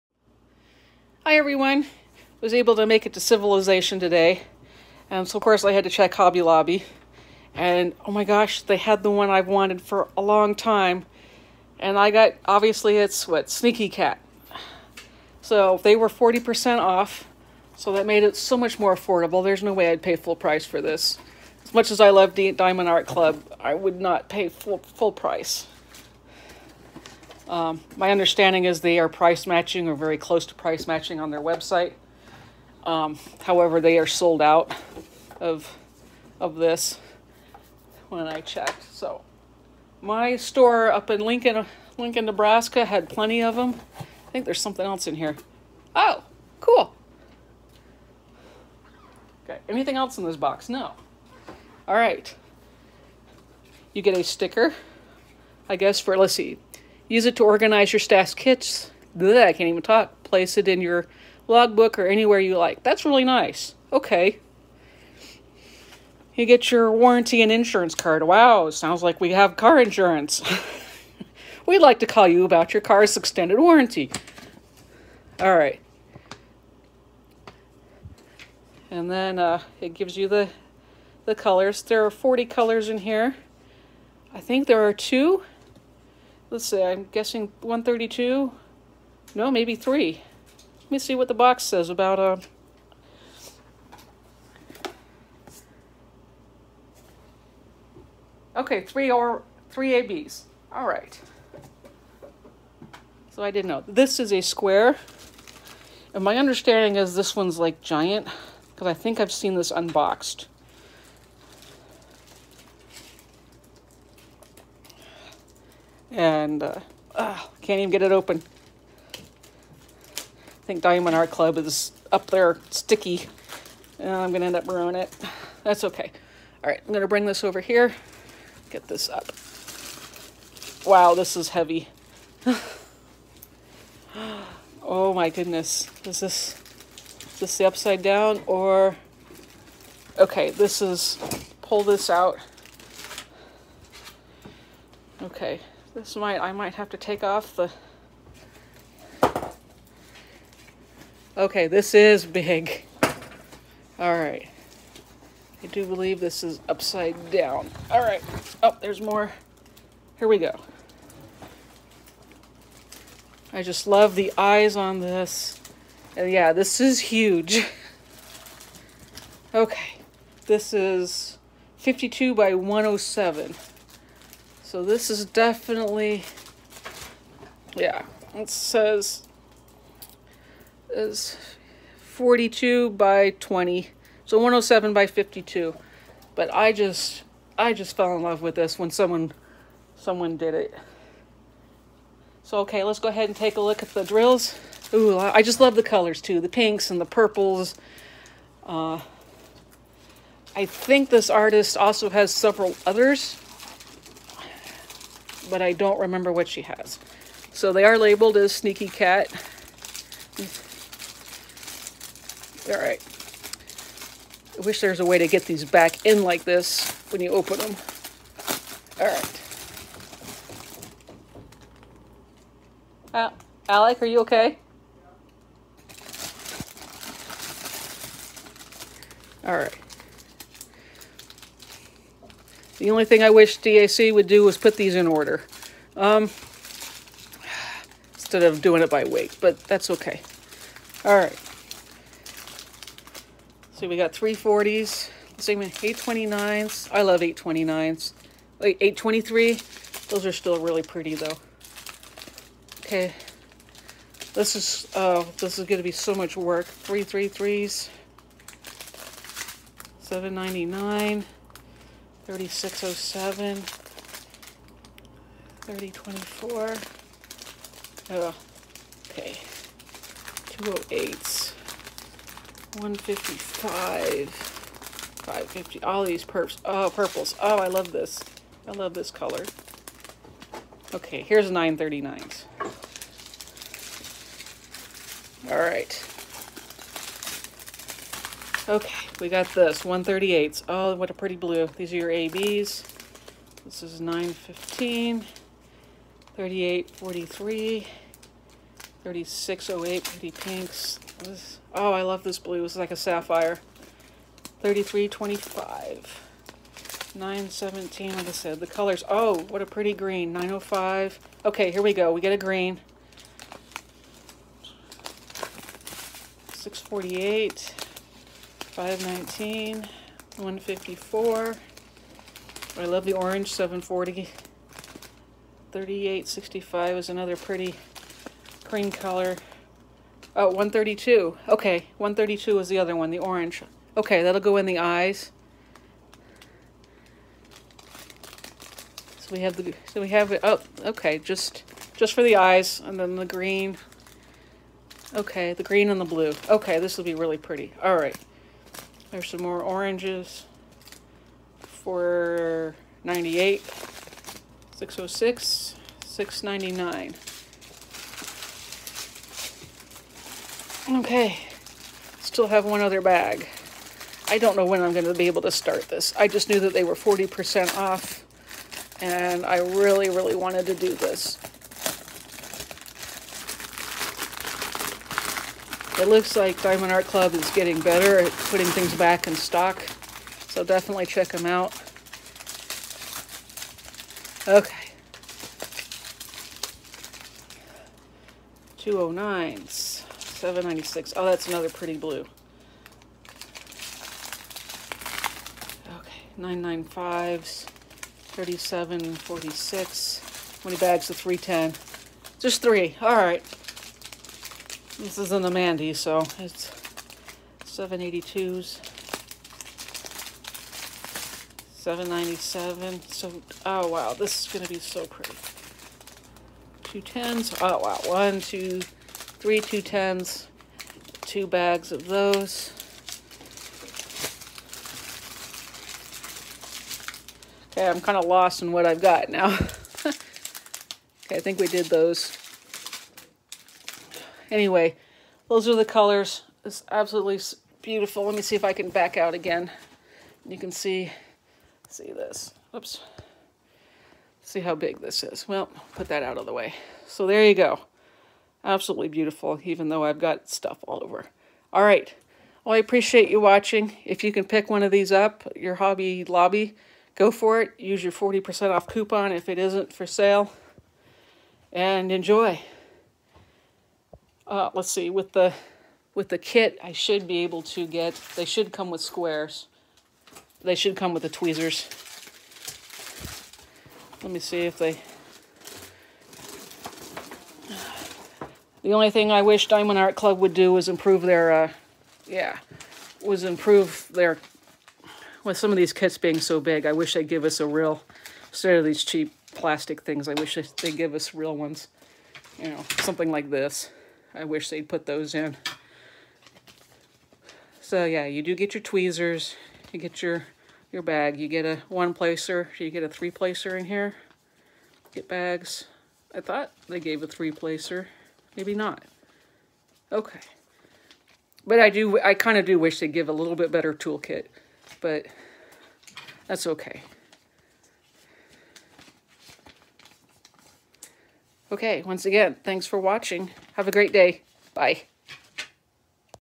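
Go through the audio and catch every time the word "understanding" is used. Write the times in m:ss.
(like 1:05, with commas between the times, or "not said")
0:28, 1:46.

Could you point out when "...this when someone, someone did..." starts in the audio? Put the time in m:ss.
3:08.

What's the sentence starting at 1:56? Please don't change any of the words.
and uh, can't even get it open.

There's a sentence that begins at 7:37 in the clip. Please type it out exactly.
Use your 40% off coupon if it isn't for sale.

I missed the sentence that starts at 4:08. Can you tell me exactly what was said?
Like 823, those are still really pretty though.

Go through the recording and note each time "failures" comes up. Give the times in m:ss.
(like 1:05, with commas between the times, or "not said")
not said.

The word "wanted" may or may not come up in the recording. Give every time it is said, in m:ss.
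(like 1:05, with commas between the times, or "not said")
0:09, 6:10.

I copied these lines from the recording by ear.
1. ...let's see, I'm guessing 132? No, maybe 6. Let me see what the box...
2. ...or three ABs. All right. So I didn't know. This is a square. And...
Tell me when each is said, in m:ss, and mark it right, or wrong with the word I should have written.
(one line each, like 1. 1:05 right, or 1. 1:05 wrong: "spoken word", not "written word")
1. 1:26 wrong: "3", not "6"
2. 1:39 right.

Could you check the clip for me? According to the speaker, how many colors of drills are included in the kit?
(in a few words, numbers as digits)
40.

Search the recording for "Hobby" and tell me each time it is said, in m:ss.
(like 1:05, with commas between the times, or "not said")
0:06, 7:35.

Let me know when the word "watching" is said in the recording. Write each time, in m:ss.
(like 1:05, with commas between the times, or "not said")
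7:33, 8:42.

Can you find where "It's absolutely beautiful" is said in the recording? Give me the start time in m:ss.
7:16.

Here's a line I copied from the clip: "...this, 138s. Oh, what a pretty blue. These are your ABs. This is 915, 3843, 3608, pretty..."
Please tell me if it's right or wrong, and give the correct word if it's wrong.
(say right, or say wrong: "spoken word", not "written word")
right.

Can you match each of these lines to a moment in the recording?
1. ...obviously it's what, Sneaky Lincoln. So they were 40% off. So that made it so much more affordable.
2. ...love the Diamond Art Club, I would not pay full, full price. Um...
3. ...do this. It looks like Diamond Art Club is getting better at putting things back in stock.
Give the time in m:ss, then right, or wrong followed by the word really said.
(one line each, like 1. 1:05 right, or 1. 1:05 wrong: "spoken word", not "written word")
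1. 0:12 wrong: "Cat", not "Lincoln"
2. 0:22 right
3. 6:10 right.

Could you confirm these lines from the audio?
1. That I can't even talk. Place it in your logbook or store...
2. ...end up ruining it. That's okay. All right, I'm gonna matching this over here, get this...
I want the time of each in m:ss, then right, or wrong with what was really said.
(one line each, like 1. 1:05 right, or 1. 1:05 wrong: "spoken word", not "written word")
1. 0:59 wrong: "anywhere", not "store"
2. 2:04 wrong: "bring", not "matching".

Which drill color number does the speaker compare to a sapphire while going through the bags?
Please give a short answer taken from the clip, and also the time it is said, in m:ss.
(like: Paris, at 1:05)
3325, at 5:04.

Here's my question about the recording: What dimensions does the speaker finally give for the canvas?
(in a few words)
107 by 52.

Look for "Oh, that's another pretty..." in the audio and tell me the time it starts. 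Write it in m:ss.
6:31.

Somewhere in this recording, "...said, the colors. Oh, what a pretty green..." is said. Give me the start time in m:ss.
5:08.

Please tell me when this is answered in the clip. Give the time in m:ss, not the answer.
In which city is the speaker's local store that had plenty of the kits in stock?
0:41.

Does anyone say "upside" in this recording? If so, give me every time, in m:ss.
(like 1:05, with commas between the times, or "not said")
2:17, 2:36.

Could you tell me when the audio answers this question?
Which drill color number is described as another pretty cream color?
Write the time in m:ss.
5:25.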